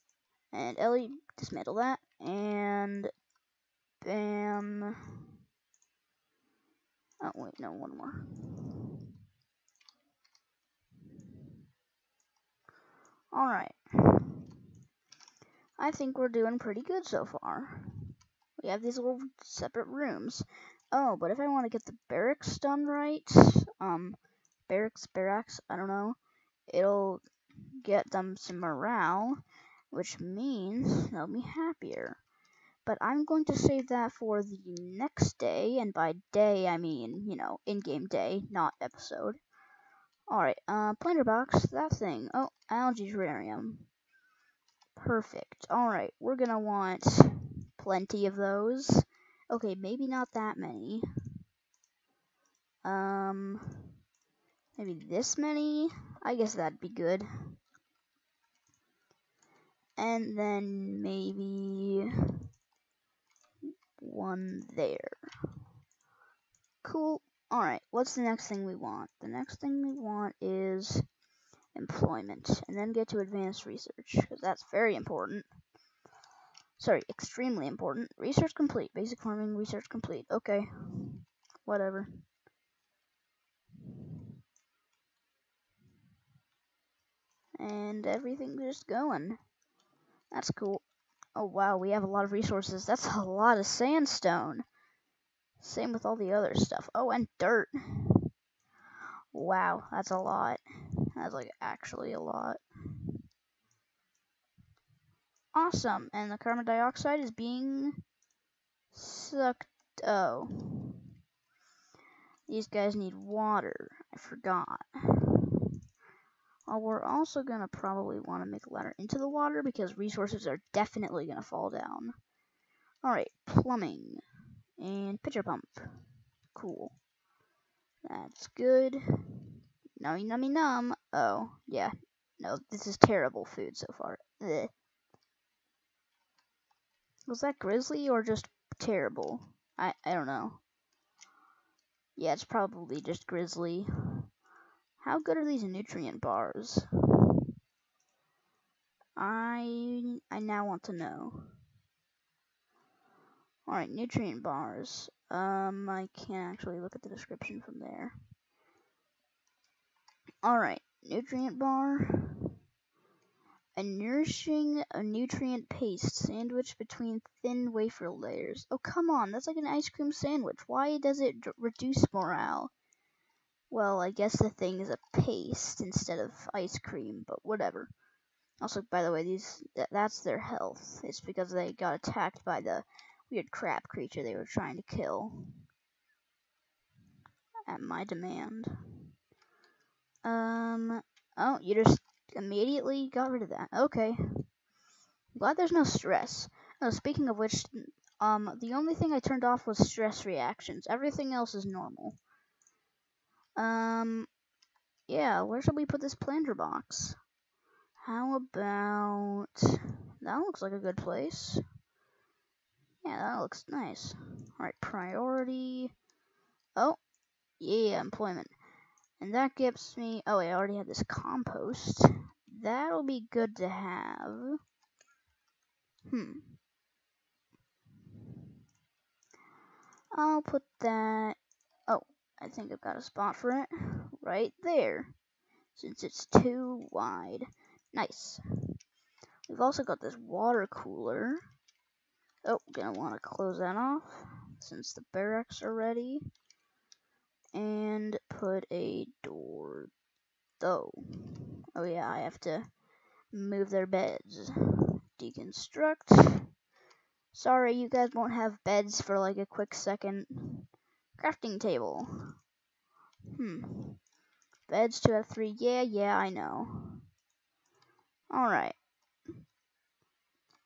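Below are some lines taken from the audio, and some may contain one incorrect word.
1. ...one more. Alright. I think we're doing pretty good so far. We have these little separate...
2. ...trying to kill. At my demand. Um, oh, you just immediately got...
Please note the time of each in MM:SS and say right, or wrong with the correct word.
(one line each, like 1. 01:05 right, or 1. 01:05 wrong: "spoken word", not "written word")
1. 00:07 right
2. 03:04 right.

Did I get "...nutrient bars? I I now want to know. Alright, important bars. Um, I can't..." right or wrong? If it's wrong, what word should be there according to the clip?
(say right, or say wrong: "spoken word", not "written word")
wrong: "nutrient", not "important".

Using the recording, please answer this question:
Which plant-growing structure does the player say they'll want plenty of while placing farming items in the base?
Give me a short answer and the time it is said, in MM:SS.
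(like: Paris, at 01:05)
Algae terrarium, at 00:42.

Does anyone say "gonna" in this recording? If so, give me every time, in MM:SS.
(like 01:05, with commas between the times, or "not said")
00:46, 04:02.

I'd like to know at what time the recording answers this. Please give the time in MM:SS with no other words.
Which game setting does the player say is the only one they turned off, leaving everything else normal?
03:19.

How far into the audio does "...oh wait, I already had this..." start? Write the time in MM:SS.
03:40.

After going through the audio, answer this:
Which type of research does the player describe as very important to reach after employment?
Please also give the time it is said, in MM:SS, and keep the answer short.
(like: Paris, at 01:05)
Advanced research, at 01:13.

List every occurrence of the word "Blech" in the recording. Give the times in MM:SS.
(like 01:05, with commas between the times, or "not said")
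02:14.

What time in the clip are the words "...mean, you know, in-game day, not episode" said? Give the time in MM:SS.
00:36.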